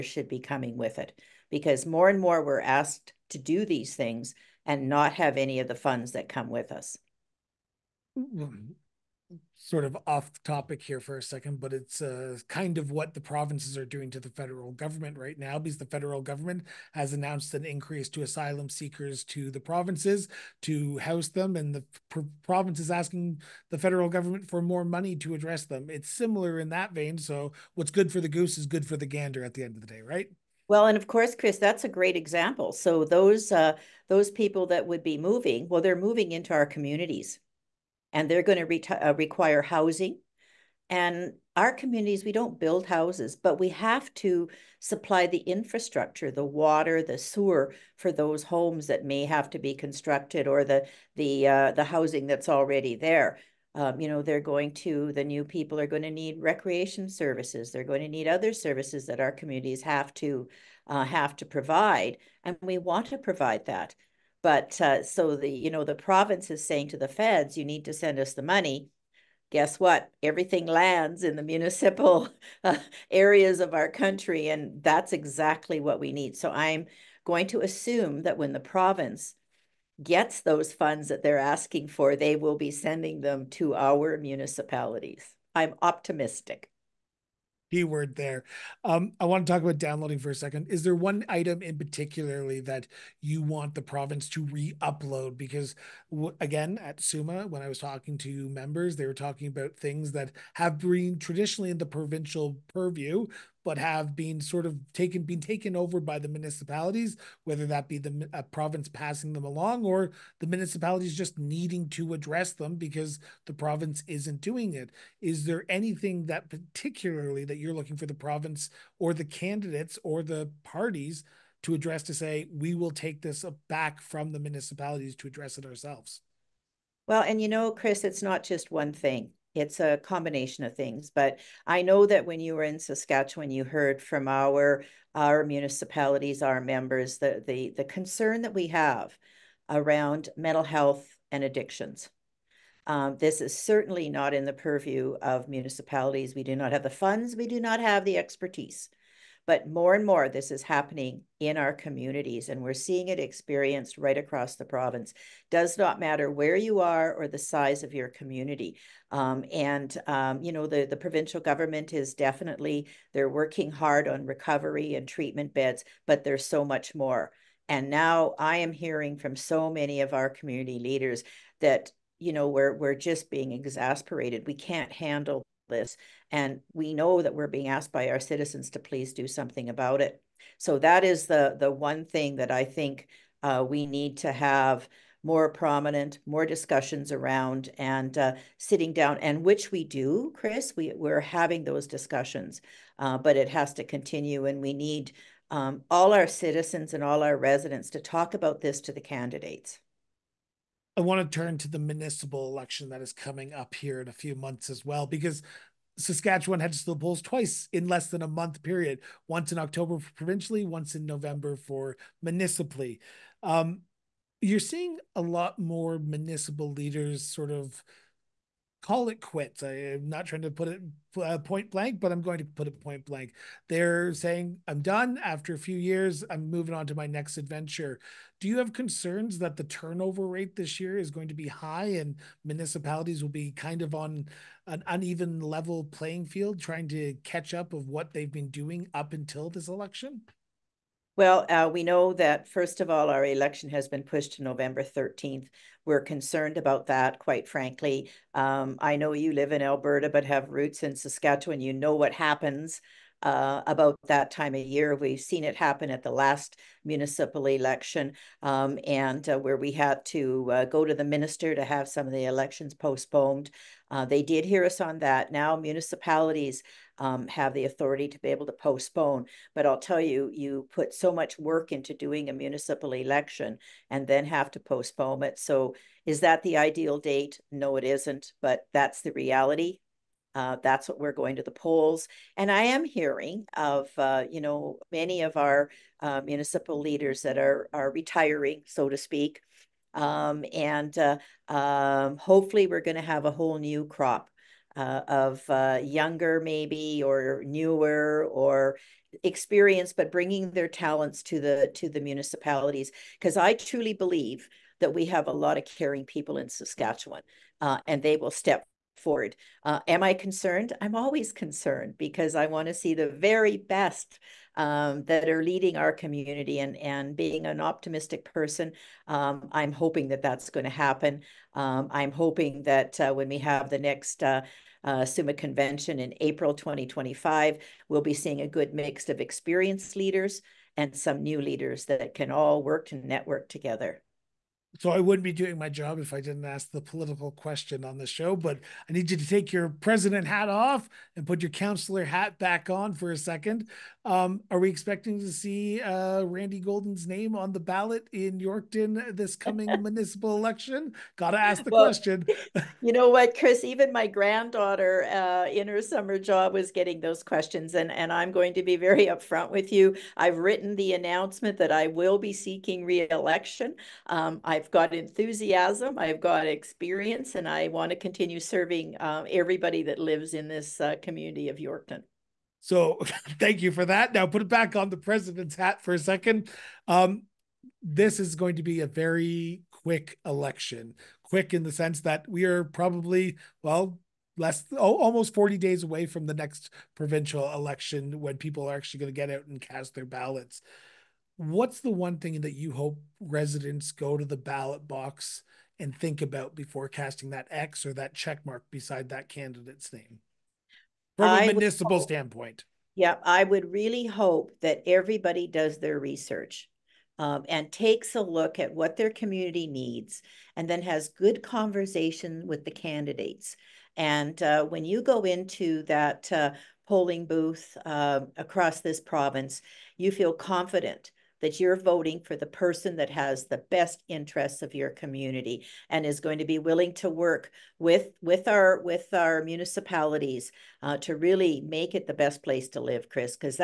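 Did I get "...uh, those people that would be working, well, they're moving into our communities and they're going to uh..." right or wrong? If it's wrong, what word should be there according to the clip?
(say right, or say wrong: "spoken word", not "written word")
wrong: "moving", not "working".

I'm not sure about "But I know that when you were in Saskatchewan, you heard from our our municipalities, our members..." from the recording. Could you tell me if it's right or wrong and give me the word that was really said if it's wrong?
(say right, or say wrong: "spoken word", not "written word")
right.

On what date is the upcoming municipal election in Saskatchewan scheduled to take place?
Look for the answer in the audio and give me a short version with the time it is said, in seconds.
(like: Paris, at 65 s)
November 13th, at 244 s.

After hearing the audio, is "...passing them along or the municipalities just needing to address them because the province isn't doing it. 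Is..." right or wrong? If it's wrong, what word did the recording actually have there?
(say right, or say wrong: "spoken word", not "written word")
right.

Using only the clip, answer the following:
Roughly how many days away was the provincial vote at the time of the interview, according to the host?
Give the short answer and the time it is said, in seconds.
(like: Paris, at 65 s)
40, at 385 s.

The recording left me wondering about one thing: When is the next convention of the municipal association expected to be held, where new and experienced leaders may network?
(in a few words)
April 2025.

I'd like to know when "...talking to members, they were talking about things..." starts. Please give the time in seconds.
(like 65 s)
97 s.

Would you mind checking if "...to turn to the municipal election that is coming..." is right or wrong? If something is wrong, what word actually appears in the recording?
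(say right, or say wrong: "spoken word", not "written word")
right.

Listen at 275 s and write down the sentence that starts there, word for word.
So is that the ideal date?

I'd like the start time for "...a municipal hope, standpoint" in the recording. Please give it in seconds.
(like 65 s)
401 s.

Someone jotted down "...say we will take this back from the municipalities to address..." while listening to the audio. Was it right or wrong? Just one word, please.
right.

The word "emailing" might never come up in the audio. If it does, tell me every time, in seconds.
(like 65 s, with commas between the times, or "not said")
not said.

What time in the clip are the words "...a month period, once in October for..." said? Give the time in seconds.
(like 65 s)
208 s.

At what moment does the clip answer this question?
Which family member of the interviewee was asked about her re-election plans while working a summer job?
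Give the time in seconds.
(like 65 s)
354 s.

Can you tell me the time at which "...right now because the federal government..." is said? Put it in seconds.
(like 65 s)
15 s.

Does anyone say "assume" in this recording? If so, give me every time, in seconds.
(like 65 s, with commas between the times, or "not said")
77 s.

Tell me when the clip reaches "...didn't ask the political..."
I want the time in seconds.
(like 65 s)
336 s.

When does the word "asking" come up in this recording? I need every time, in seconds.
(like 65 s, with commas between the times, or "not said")
22 s, 81 s.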